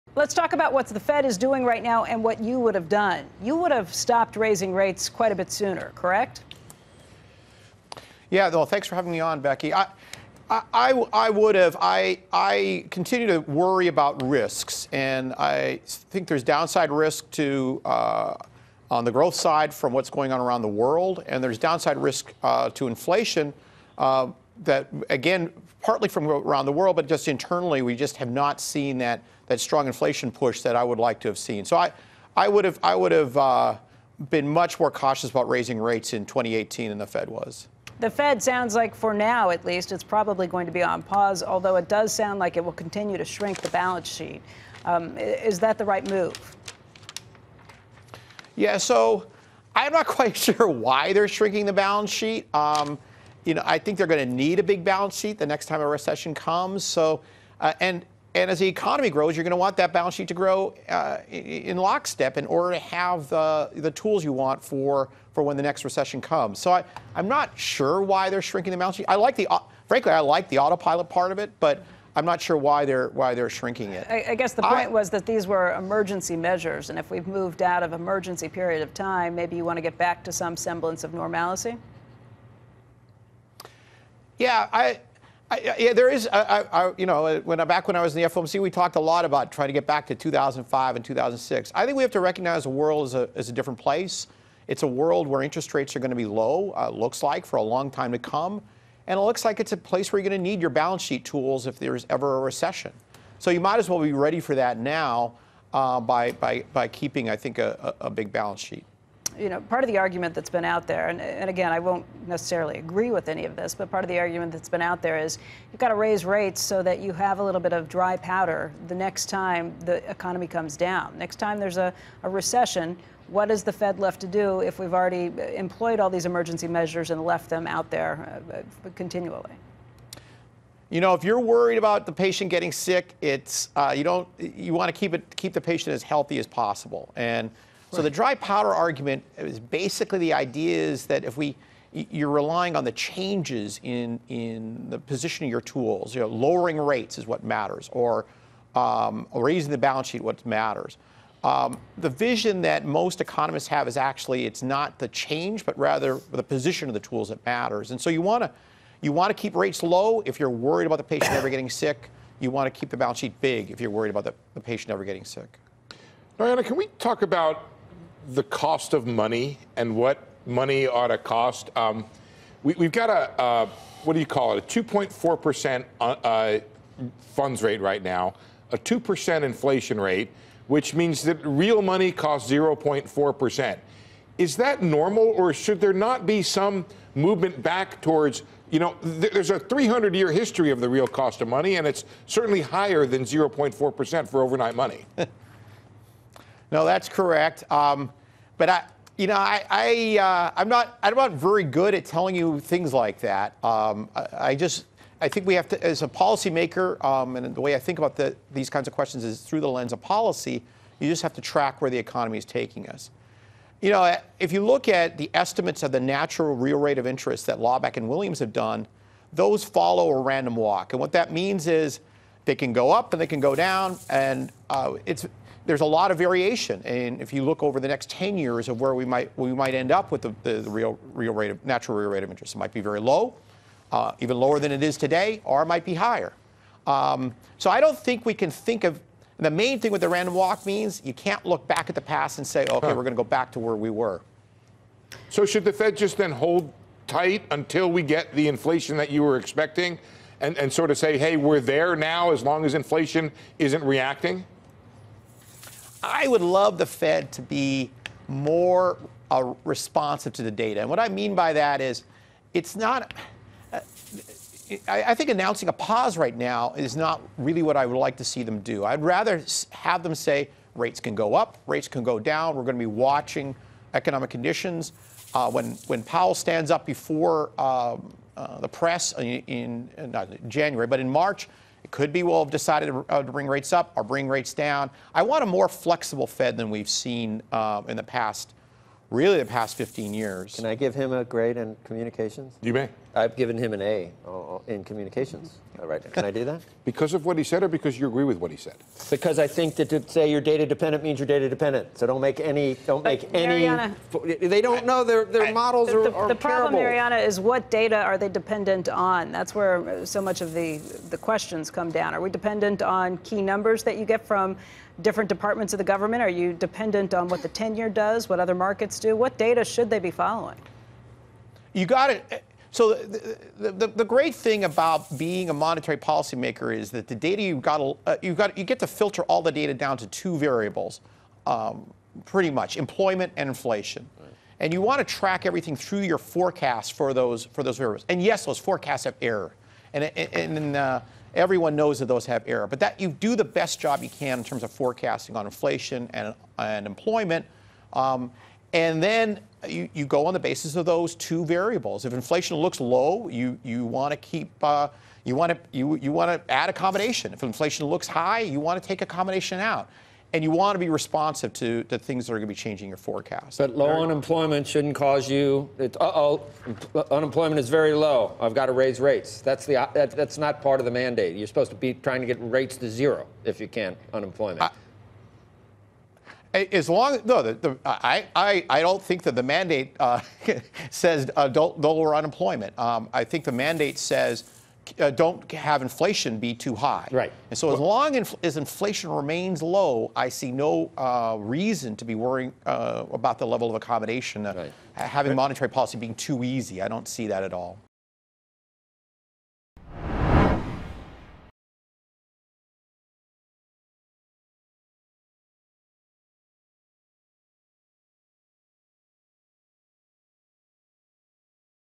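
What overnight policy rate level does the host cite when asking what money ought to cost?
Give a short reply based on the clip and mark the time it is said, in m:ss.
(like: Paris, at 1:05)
2.4%, at 2:54.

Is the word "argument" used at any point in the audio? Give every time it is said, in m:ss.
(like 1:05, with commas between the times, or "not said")
1:49, 1:54, 2:18.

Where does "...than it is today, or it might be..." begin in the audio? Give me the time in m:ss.
3:54.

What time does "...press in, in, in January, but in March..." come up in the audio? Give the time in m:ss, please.
4:38.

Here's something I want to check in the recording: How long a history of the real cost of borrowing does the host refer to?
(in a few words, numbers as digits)
300 years.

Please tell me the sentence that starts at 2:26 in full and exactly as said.
You know, lowering rates is what matters, or um, raising the balance sheet what matters.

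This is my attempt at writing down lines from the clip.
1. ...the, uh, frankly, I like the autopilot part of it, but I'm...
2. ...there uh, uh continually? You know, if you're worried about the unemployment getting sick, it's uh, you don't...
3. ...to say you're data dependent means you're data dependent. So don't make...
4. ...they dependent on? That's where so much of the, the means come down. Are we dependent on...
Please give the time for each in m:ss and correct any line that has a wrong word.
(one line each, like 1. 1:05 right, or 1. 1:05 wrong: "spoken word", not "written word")
1. 1:09 right
2. 2:07 wrong: "patient", not "unemployment"
3. 4:59 right
4. 5:08 wrong: "questions", not "means".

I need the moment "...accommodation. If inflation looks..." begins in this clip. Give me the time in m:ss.
5:56.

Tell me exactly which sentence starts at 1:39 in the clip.
And it looks like it's a place where you're going to need your balance sheet tools if there's ever a recession.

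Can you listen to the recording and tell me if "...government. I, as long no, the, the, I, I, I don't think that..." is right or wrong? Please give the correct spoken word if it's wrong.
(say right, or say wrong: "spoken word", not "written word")
wrong: "unemployment", not "government".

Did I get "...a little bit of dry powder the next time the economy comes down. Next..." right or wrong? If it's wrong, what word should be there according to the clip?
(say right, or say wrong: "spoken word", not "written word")
right.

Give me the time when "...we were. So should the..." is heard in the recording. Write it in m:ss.
4:03.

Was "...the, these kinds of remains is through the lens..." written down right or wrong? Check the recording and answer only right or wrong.
wrong.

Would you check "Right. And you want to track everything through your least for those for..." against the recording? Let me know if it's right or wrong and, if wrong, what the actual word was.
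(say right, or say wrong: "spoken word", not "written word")
wrong: "forecast", not "least".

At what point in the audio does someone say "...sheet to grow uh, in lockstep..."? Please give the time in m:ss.
1:00.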